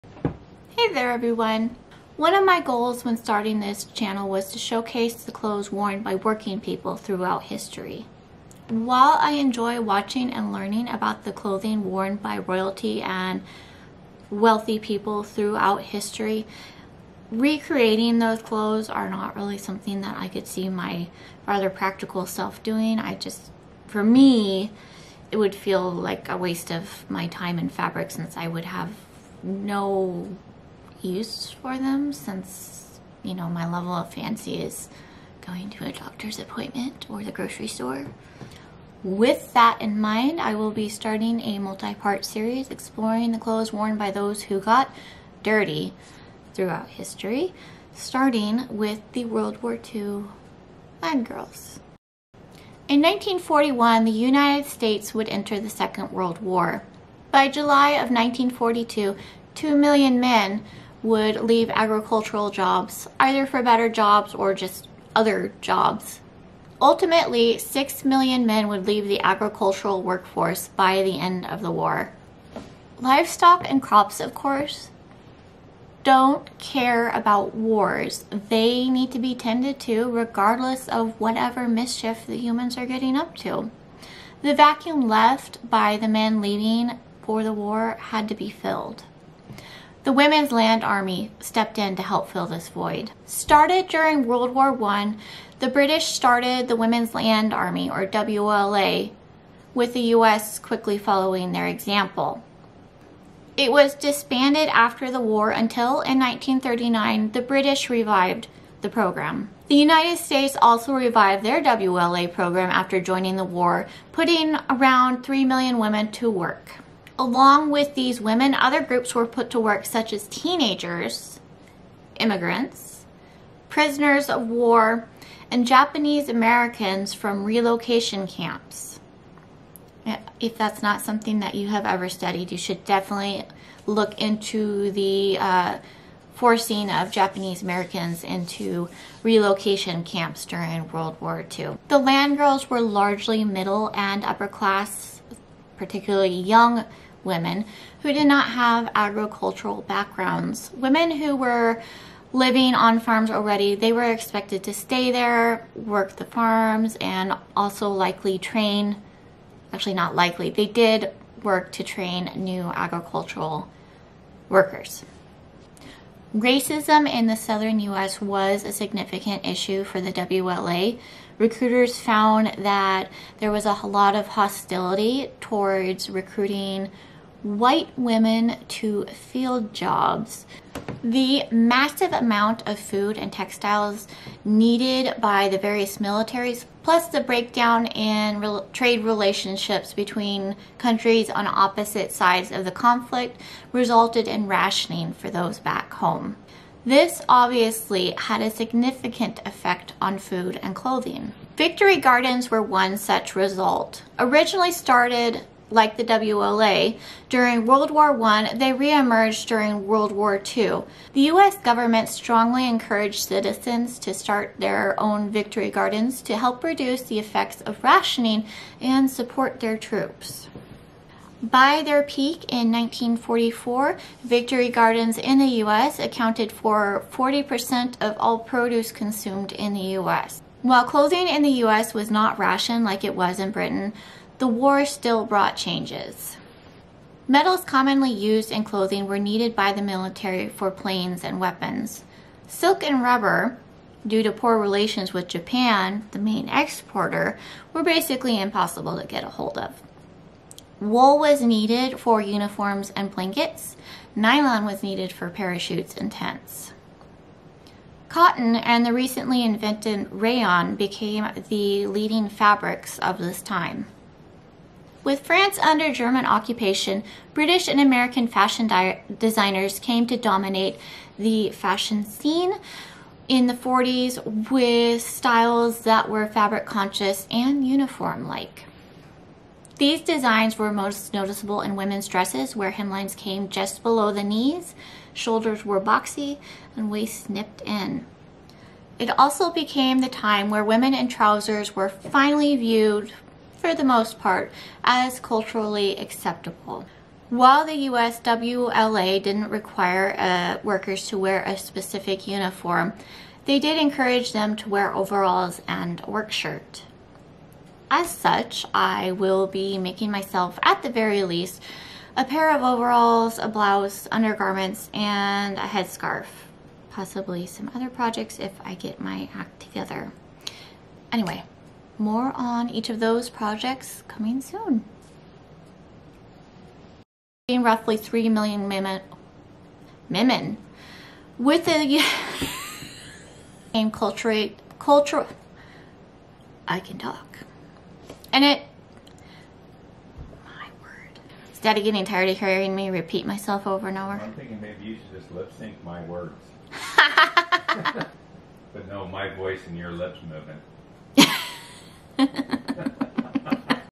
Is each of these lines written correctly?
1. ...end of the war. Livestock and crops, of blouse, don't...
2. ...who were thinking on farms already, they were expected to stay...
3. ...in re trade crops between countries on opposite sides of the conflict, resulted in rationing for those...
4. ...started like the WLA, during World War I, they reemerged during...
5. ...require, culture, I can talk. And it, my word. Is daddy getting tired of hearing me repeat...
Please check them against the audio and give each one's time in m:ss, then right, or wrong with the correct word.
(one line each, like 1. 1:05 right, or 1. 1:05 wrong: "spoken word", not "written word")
1. 1:11 wrong: "course", not "blouse"
2. 2:31 wrong: "living", not "thinking"
3. 3:07 wrong: "relationships", not "crops"
4. 3:24 right
5. 5:33 wrong: "culture", not "require".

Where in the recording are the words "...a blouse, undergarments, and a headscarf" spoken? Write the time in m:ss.
5:13.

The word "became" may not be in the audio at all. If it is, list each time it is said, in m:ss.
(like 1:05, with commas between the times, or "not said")
4:20, 4:49.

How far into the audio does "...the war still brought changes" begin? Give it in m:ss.
3:54.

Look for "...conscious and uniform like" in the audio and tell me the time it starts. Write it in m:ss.
4:36.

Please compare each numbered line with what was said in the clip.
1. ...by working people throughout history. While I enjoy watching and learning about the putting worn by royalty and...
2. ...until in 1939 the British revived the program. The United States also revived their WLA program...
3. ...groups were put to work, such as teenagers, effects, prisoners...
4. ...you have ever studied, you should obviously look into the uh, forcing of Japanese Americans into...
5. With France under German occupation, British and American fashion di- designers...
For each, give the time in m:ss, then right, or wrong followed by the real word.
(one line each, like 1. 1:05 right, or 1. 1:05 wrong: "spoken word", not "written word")
1. 0:06 wrong: "clothing", not "putting"
2. 1:45 right
3. 1:58 wrong: "immigrants", not "effects"
4. 2:11 wrong: "definitely", not "obviously"
5. 4:25 right.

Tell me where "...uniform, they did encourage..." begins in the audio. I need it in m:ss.
5:02.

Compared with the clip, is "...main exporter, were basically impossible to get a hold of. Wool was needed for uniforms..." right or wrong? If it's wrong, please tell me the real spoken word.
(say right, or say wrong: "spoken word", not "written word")
right.